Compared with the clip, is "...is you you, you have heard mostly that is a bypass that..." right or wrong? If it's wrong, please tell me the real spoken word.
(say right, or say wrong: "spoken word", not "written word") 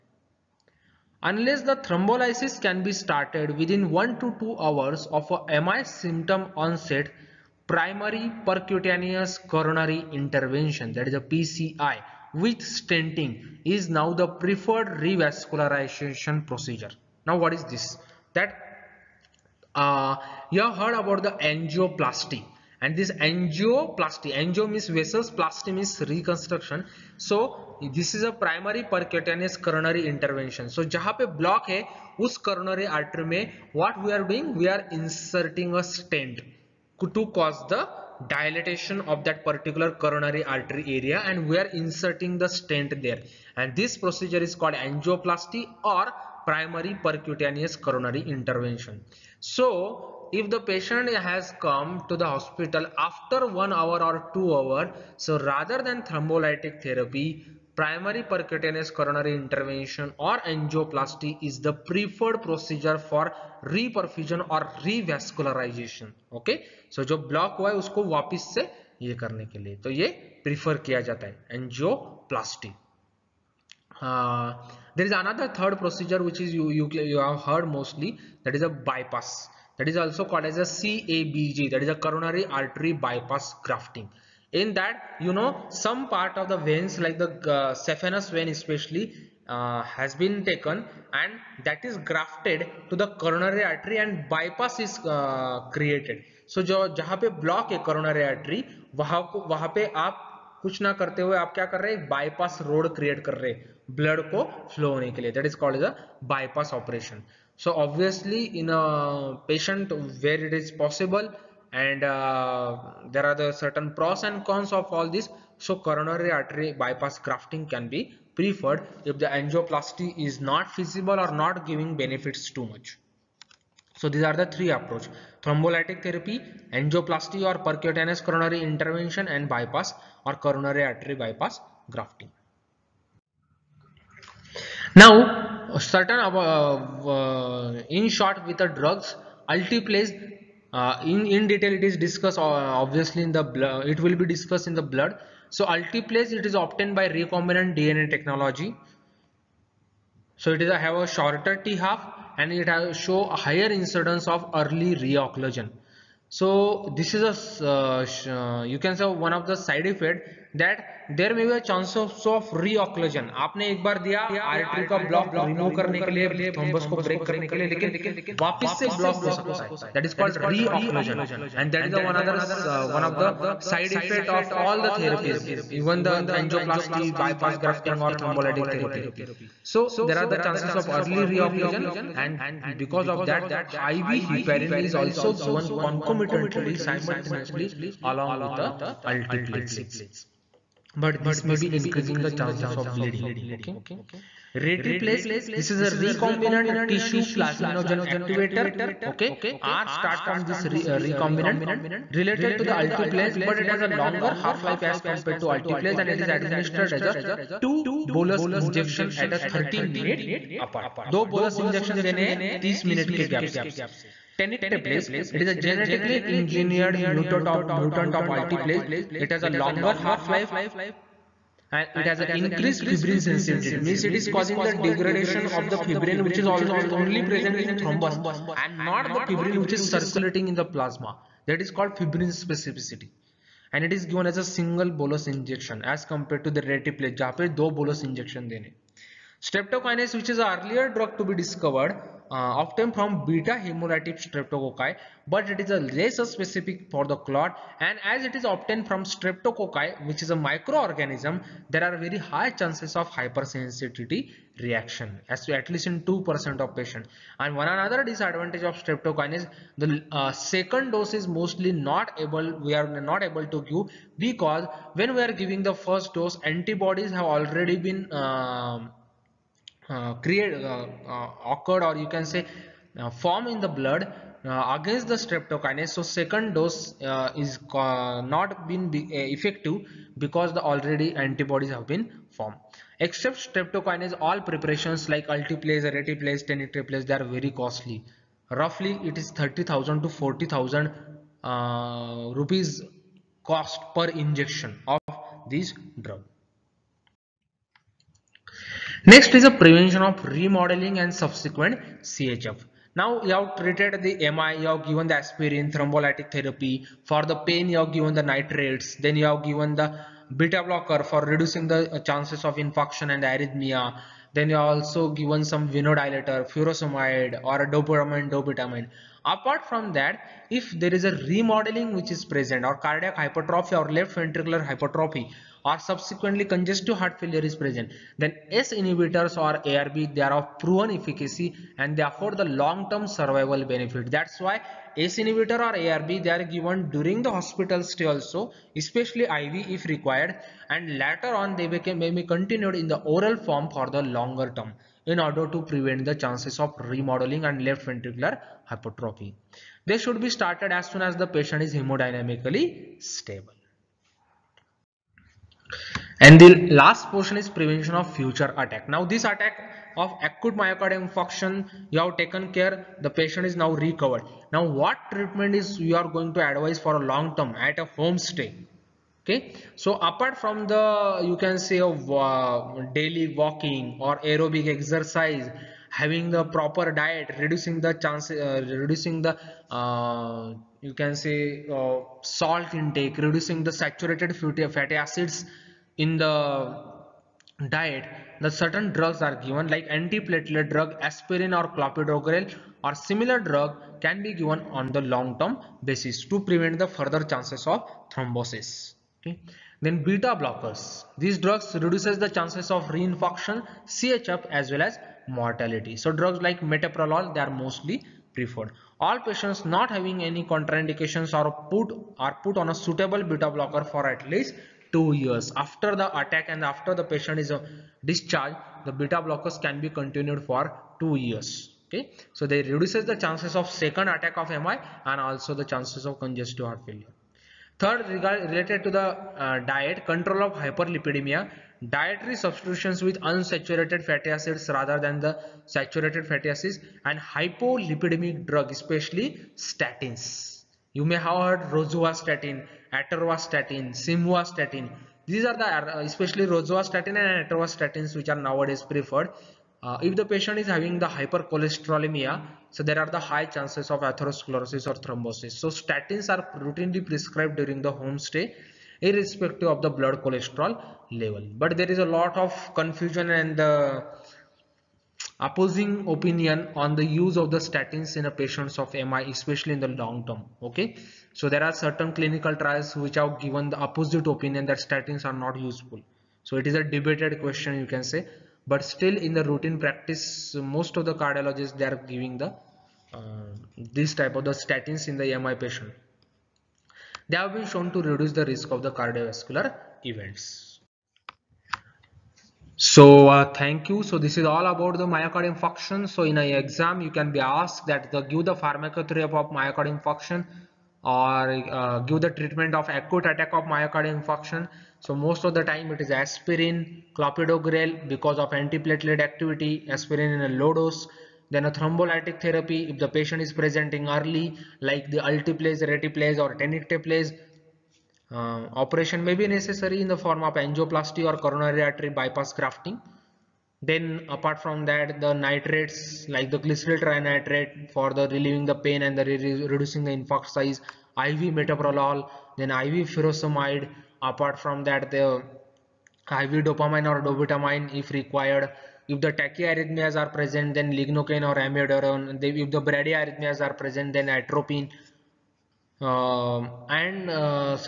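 right.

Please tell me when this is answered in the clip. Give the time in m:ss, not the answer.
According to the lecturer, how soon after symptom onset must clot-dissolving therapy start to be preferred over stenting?
0:03.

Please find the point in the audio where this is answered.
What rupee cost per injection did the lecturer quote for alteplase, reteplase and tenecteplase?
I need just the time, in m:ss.
4:49.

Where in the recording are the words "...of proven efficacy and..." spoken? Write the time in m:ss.
5:30.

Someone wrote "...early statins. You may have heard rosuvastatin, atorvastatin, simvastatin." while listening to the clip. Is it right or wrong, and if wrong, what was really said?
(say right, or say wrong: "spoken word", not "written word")
wrong: "especially", not "early".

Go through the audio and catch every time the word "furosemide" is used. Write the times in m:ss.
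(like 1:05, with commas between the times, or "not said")
5:16, 8:53.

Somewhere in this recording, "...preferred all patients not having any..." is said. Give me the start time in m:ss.
6:48.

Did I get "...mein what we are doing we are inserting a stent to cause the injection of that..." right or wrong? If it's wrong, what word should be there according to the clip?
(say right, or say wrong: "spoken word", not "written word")
wrong: "dilatation", not "injection".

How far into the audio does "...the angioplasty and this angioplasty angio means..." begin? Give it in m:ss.
0:21.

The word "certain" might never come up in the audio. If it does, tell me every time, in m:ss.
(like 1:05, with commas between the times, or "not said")
1:53, 2:15, 6:28, 7:51.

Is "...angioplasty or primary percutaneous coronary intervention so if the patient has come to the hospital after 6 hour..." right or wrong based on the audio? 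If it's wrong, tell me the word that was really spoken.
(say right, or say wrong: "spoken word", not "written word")
wrong: "1", not "6".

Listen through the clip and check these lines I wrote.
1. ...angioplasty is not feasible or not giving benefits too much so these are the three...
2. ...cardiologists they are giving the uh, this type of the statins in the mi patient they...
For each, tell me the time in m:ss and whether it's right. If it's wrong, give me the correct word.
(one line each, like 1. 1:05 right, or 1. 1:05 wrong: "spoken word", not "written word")
1. 1:59 right
2. 8:01 right.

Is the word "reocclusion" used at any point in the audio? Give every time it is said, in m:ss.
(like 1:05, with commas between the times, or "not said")
2:35, 3:01.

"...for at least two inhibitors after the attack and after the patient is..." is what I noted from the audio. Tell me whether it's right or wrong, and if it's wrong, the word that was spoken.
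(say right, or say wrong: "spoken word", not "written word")
wrong: "years", not "inhibitors".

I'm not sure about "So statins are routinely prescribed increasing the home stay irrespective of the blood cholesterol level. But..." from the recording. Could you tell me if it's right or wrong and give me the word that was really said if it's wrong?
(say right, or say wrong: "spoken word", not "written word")
wrong: "during", not "increasing".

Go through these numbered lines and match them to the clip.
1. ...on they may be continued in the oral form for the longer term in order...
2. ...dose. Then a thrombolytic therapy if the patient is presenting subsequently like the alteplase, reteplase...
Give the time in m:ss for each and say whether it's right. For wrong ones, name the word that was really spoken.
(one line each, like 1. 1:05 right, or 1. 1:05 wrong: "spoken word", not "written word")
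1. 5:41 right
2. 8:30 wrong: "early", not "subsequently".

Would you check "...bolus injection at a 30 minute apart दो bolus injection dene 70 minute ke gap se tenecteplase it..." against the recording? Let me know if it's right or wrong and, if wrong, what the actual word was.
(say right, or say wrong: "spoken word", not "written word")
wrong: "30", not "70".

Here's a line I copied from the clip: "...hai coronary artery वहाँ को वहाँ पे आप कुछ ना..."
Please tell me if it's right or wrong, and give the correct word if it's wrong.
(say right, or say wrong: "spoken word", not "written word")
right.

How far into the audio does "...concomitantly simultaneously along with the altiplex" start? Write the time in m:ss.
3:05.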